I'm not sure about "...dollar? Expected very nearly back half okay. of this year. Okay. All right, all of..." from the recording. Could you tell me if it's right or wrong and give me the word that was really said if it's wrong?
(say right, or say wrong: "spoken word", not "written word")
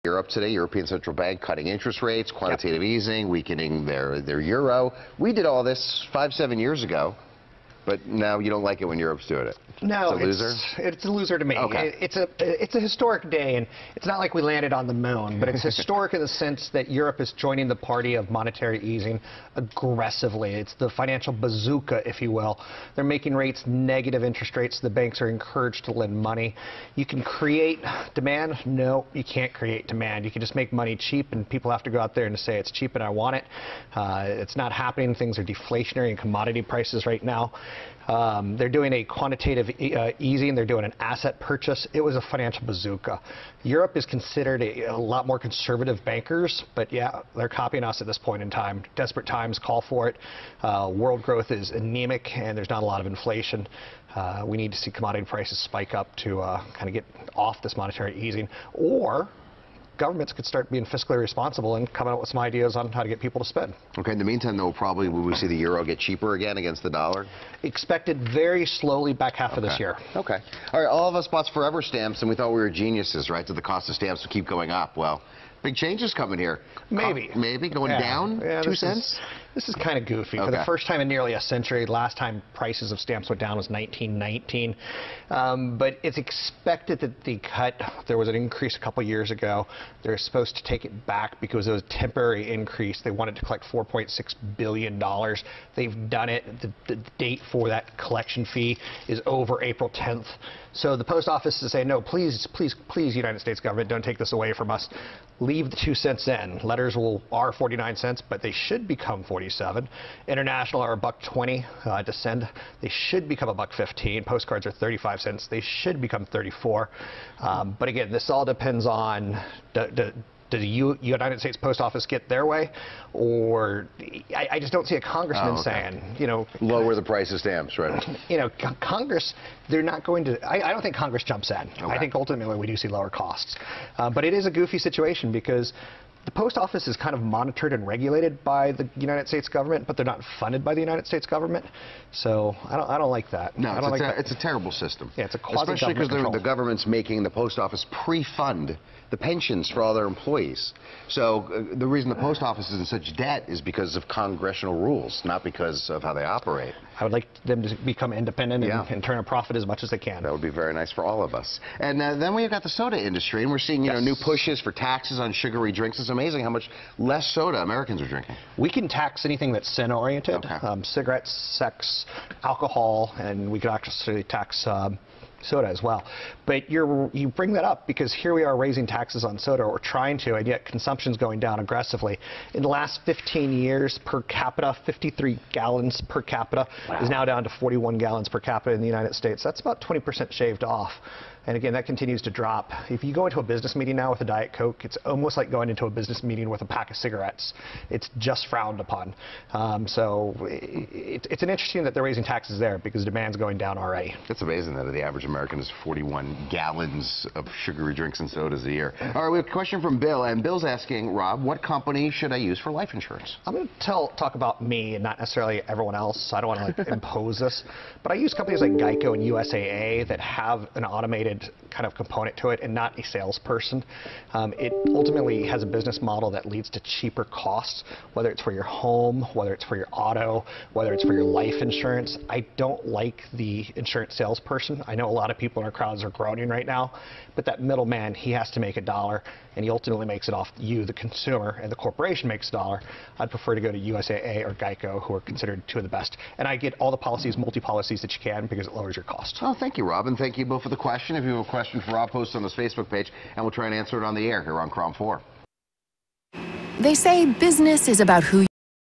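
wrong: "slowly", not "nearly".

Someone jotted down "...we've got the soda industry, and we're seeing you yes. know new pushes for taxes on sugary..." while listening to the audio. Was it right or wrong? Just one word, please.
right.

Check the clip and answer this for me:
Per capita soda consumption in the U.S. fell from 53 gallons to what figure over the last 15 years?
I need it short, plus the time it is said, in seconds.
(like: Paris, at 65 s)
41 gallons, at 187 s.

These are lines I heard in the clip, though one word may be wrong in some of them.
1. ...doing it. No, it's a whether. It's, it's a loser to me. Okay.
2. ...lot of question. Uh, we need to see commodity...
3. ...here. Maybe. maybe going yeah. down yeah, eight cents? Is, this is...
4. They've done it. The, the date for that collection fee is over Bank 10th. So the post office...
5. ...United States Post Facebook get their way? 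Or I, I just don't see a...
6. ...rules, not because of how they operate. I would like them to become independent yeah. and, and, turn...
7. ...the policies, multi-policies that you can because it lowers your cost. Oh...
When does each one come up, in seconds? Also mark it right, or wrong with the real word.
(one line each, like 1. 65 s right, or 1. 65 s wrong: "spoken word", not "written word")
1. 9 s wrong: "loser", not "whether"
2. 52 s wrong: "inflation", not "question"
3. 76 s wrong: "two", not "eight"
4. 95 s wrong: "April", not "Bank"
5. 121 s wrong: "Office", not "Facebook"
6. 154 s right
7. 246 s right.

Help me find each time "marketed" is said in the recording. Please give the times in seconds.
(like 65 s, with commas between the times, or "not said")
221 s.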